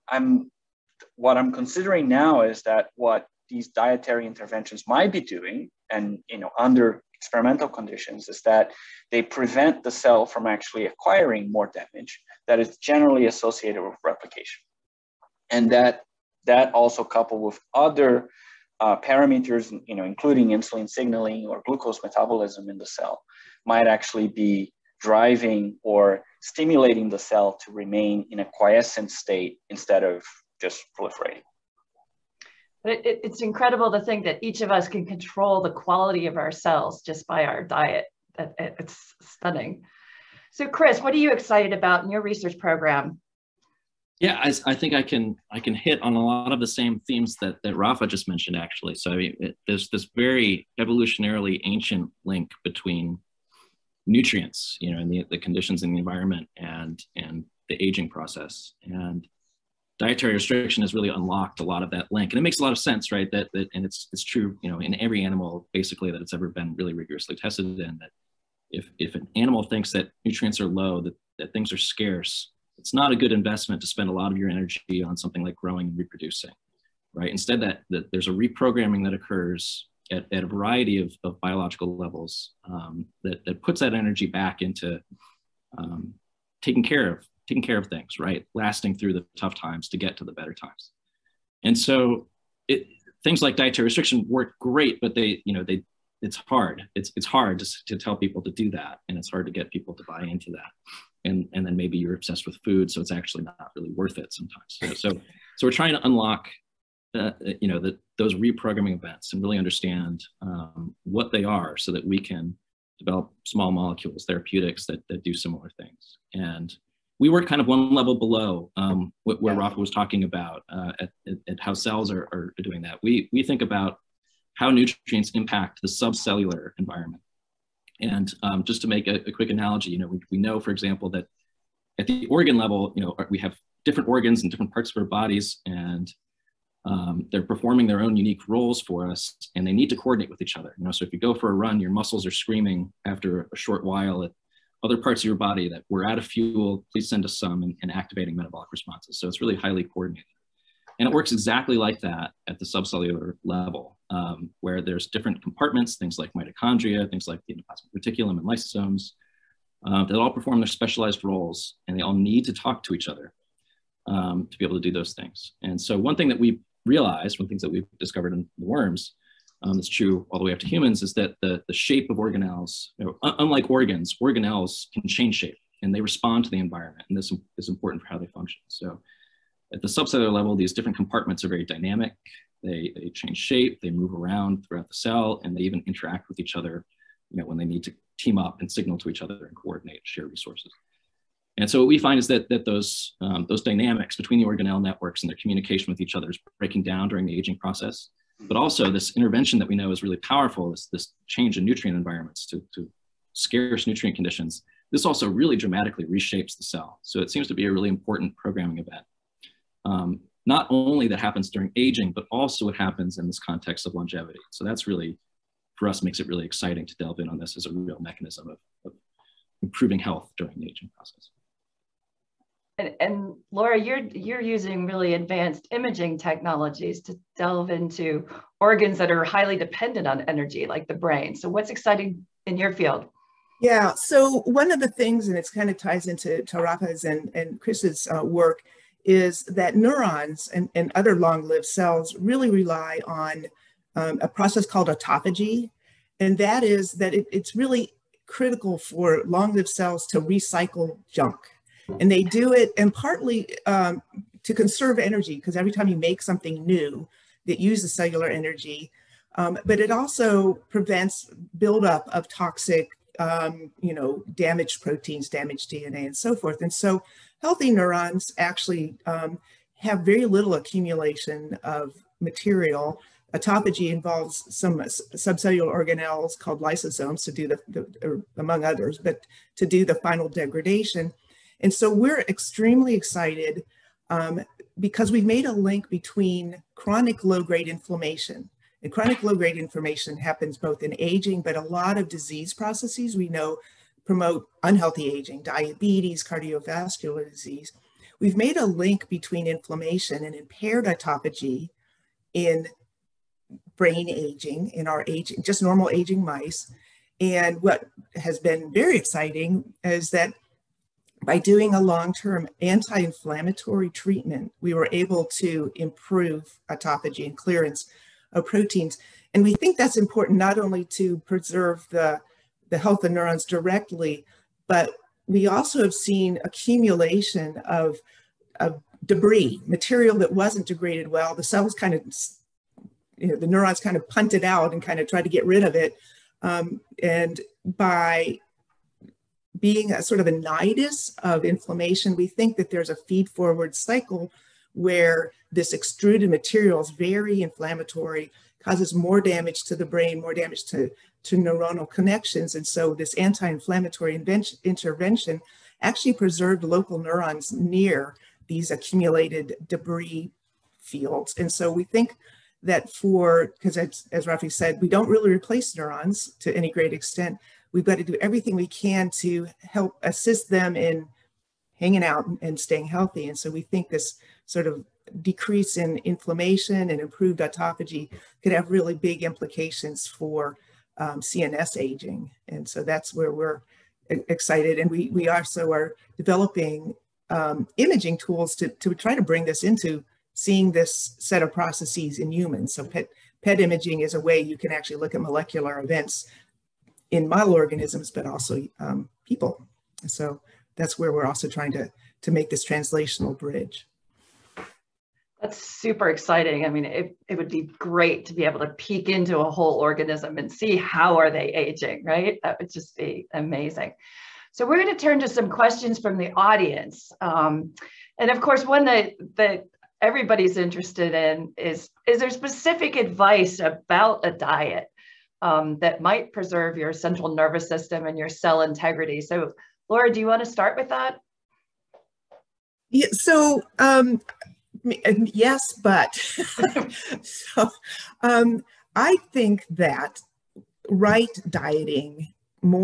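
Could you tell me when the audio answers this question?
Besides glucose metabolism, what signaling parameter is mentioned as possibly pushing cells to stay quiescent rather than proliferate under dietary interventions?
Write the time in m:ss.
0:20.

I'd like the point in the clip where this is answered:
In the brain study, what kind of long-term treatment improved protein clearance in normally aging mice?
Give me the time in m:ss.
5:12.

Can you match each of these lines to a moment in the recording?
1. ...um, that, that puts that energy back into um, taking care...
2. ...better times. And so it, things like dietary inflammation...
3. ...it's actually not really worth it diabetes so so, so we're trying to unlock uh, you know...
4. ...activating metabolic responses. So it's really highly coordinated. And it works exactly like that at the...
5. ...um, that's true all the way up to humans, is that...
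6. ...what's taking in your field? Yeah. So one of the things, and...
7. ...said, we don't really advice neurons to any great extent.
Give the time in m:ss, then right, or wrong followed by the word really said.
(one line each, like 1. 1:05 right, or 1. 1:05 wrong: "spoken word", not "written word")
1. 1:22 right
2. 1:30 wrong: "restriction", not "inflammation"
3. 1:43 wrong: "sometimes", not "diabetes"
4. 2:27 right
5. 2:49 right
6. 3:51 wrong: "exciting", not "taking"
7. 6:04 wrong: "replace", not "advice".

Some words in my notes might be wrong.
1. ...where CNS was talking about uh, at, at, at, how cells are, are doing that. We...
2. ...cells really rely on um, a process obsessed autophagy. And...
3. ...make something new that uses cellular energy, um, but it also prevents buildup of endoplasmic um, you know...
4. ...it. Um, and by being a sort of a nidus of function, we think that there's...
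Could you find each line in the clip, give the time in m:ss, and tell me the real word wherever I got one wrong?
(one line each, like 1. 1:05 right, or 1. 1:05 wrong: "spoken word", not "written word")
1. 1:59 wrong: "Rafa", not "CNS"
2. 4:01 wrong: "called", not "obsessed"
3. 4:15 wrong: "toxic", not "endoplasmic"
4. 5:35 wrong: "inflammation", not "function".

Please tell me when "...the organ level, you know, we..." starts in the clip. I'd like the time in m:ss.
2:12.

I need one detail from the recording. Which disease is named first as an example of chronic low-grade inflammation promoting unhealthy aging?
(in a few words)
diabetes.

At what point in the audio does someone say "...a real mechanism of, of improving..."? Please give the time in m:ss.
3:37.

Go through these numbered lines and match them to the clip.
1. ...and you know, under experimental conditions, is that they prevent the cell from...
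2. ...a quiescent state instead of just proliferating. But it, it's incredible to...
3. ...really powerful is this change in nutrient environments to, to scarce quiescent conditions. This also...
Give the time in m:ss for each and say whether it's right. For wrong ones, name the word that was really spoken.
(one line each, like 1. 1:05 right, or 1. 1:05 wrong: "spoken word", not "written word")
1. 0:05 right
2. 0:28 right
3. 3:20 wrong: "nutrient", not "quiescent".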